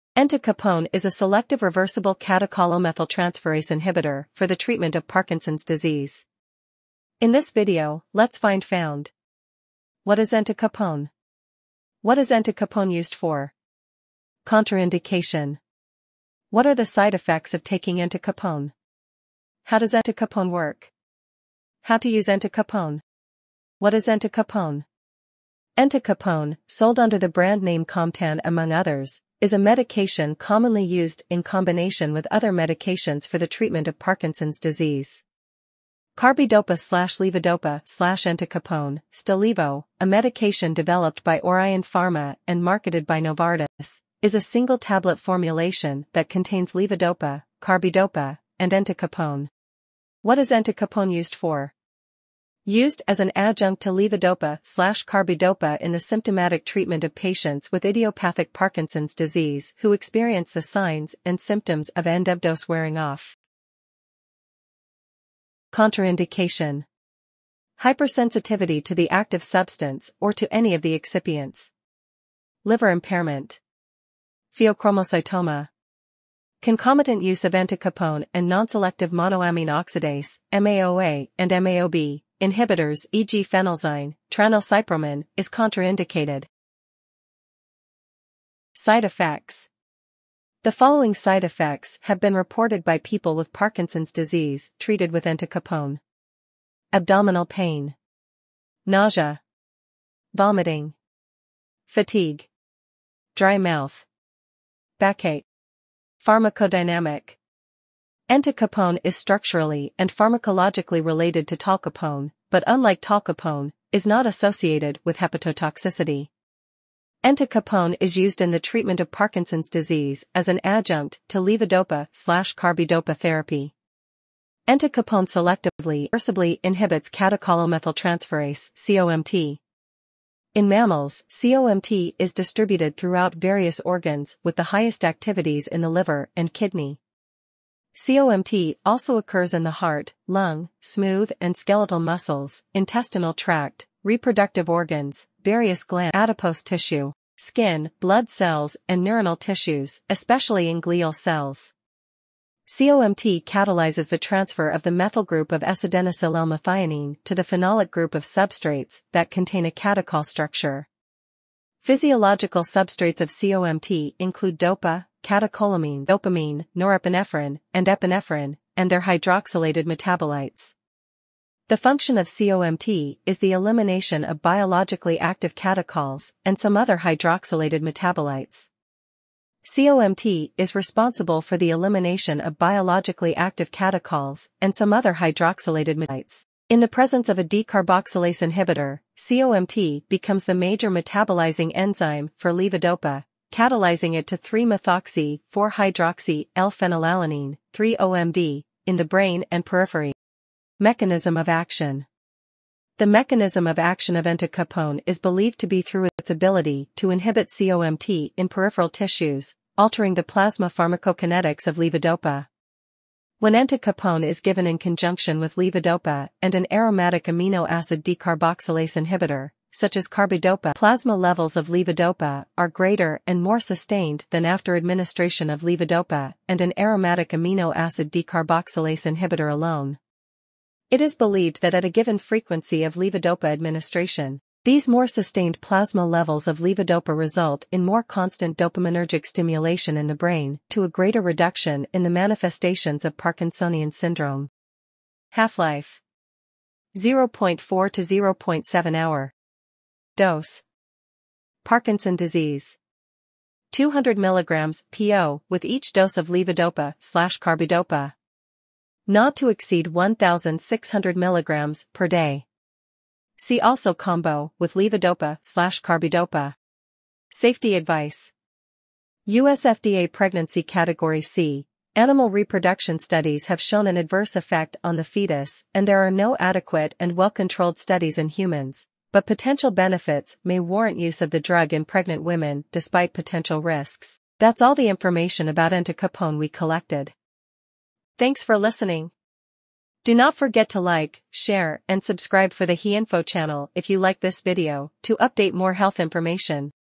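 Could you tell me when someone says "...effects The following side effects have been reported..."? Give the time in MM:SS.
01:29.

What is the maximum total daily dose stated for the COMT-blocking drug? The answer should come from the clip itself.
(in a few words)
1,600 mg.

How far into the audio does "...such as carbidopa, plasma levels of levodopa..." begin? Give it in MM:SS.
03:39.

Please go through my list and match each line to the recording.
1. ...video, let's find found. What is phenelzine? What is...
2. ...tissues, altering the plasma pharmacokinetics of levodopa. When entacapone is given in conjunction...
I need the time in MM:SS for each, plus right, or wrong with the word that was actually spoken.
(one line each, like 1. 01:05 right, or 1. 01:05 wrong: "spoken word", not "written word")
1. 00:07 wrong: "entacapone", not "phenelzine"
2. 03:28 right.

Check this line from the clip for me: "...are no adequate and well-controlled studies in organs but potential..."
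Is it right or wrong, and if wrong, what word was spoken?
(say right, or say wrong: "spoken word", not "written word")
wrong: "humans", not "organs".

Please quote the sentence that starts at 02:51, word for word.
The function of COMT is the elimination of biologically active catechols and some other hydroxylated metabolites.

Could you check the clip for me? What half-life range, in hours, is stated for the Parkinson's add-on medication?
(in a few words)
0.4 to 0.7 hours.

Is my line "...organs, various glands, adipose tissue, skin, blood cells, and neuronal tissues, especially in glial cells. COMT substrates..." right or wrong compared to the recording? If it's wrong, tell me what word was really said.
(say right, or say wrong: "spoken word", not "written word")
wrong: "catalyzes", not "substrates".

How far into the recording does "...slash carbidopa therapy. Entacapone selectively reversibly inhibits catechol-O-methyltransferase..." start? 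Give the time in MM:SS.
02:02.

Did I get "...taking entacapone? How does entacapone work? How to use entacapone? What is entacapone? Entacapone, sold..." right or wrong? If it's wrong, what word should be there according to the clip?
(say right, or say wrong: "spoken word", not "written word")
right.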